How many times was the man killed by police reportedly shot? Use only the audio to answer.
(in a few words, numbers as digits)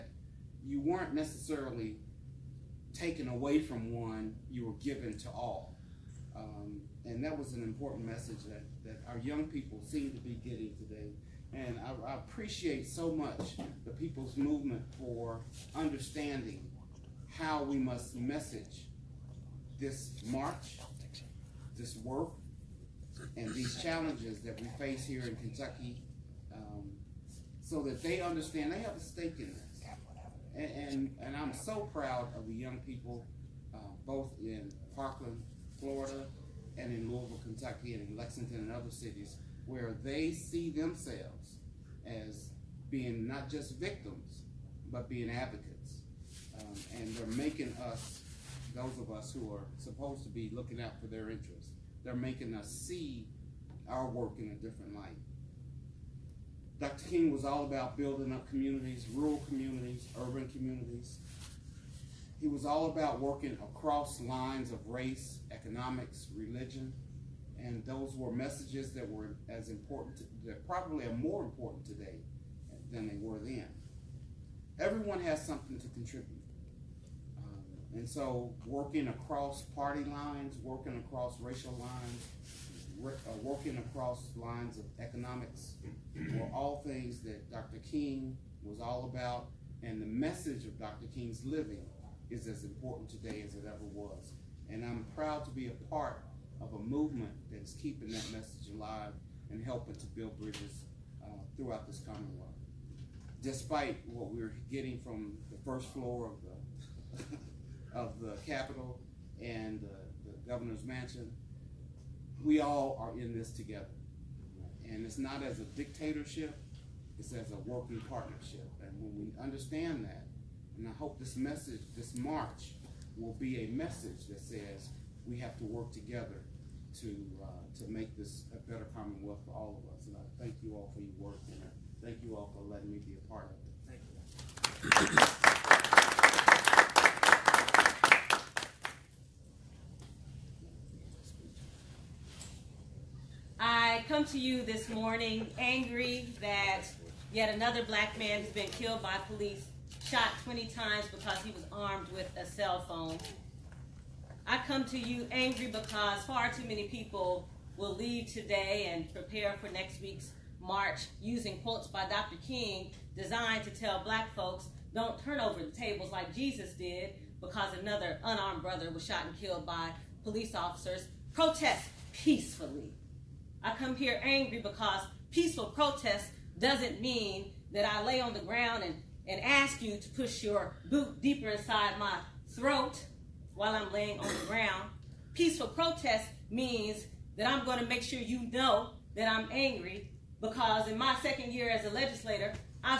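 20.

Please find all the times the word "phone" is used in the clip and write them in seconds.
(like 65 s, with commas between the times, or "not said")
152 s.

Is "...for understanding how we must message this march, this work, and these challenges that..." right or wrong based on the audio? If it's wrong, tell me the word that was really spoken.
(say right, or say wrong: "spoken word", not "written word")
right.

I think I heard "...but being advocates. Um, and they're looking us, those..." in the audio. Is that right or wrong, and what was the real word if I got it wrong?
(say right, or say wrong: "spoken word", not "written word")
wrong: "making", not "looking".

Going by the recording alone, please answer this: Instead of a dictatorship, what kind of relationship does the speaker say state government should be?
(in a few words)
A working partnership.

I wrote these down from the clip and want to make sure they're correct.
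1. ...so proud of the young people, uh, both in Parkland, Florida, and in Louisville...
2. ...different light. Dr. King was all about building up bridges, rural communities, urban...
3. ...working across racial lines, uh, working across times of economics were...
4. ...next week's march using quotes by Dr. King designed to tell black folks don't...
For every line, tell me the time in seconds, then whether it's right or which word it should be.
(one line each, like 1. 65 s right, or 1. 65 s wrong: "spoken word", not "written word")
1. 31 s right
2. 54 s wrong: "communities", not "bridges"
3. 80 s wrong: "lines", not "times"
4. 159 s right.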